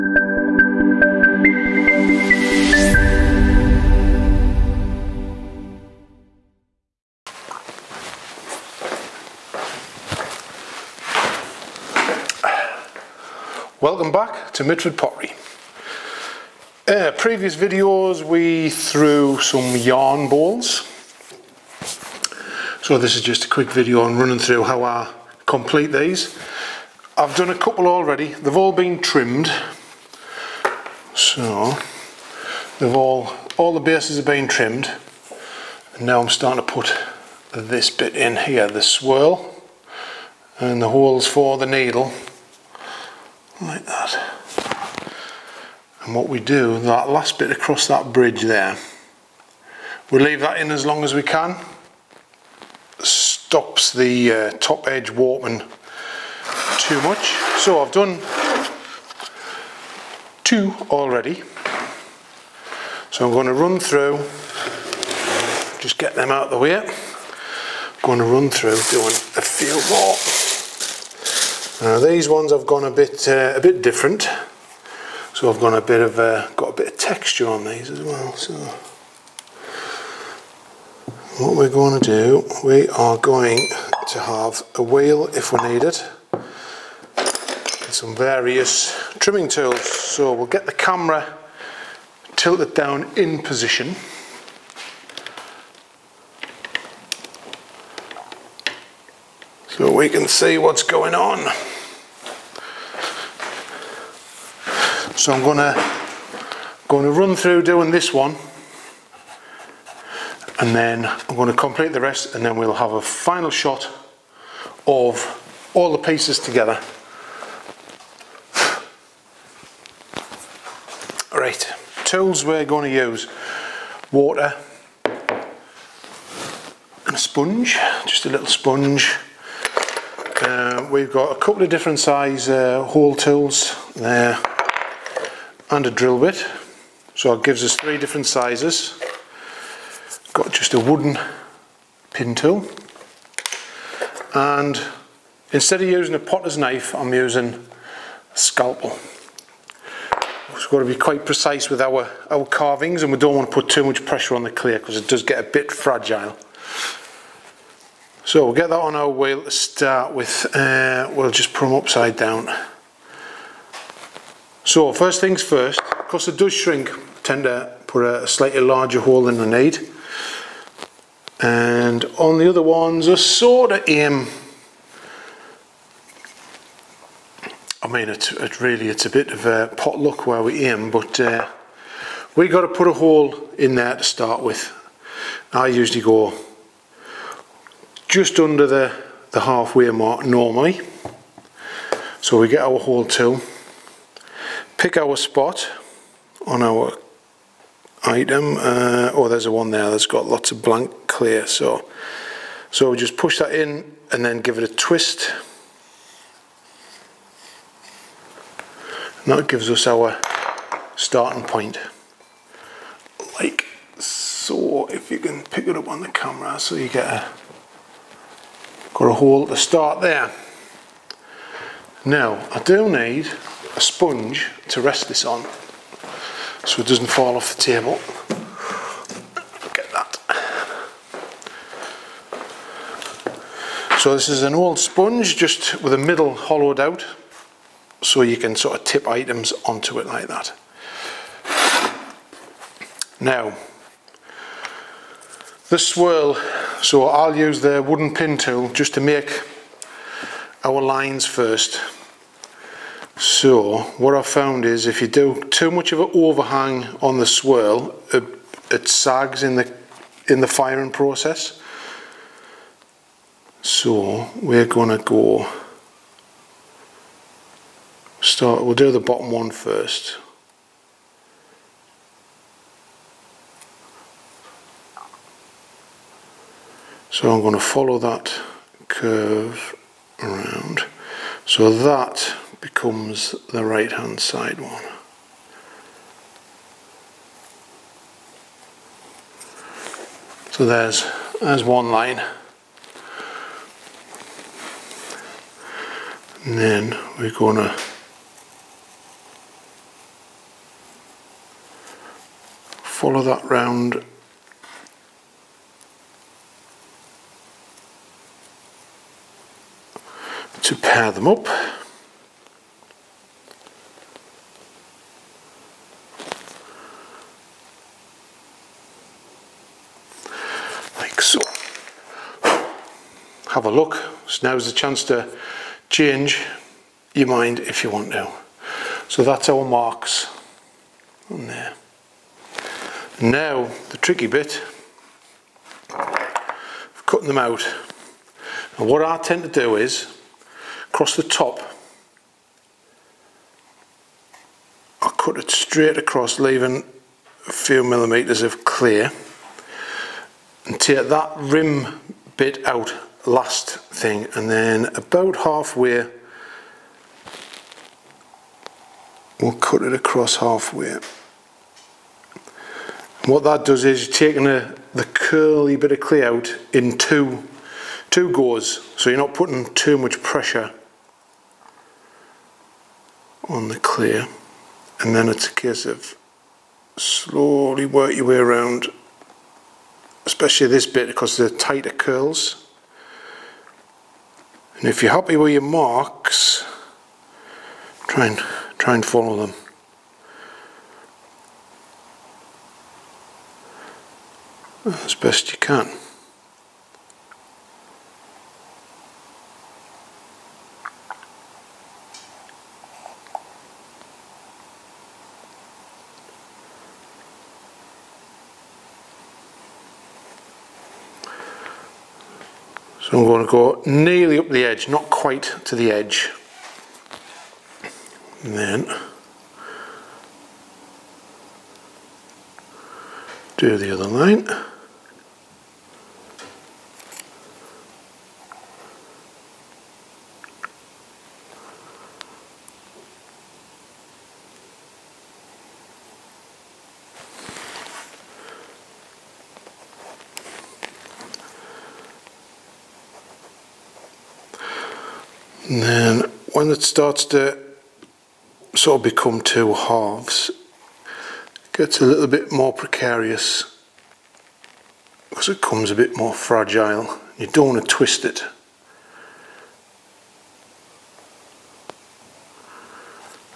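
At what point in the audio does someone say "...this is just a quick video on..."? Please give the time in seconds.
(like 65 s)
22 s.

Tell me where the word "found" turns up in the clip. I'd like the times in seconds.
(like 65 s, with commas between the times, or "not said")
254 s.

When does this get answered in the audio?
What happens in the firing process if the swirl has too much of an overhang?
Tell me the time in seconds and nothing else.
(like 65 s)
258 s.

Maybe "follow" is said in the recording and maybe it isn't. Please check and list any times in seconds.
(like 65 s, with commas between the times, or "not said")
277 s, 302 s, 389 s.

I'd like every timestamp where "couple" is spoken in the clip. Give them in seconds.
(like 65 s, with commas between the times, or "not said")
27 s, 131 s.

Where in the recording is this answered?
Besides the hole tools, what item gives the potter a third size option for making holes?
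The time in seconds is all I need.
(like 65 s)
135 s.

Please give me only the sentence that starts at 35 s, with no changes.
And now I'm starting to put this bit in here, the swirl and the holes for the needle like that.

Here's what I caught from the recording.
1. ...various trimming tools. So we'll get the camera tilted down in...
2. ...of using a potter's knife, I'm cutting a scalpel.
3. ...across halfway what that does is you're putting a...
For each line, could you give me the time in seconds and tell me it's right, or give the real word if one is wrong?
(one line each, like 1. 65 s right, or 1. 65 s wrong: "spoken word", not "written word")
1. 88 s right
2. 145 s wrong: "using", not "cutting"
3. 359 s wrong: "taking", not "putting".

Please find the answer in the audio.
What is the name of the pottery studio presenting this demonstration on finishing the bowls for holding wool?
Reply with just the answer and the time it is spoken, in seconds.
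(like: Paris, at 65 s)
Mitford Pottery, at 14 s.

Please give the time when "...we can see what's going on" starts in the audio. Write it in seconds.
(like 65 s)
99 s.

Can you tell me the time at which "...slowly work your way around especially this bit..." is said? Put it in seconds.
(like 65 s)
376 s.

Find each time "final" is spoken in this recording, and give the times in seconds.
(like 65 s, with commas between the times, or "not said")
113 s.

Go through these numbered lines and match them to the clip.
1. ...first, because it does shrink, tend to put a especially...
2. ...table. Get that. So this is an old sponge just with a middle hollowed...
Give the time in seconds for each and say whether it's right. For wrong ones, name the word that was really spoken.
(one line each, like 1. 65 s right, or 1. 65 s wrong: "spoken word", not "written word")
1. 165 s wrong: "slightly", not "especially"
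2. 227 s right.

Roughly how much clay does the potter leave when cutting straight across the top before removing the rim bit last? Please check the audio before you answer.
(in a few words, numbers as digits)
a few millimetres.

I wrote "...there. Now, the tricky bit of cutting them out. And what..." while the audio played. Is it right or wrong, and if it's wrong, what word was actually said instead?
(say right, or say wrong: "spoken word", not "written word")
right.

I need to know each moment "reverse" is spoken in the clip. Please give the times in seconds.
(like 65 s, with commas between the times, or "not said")
not said.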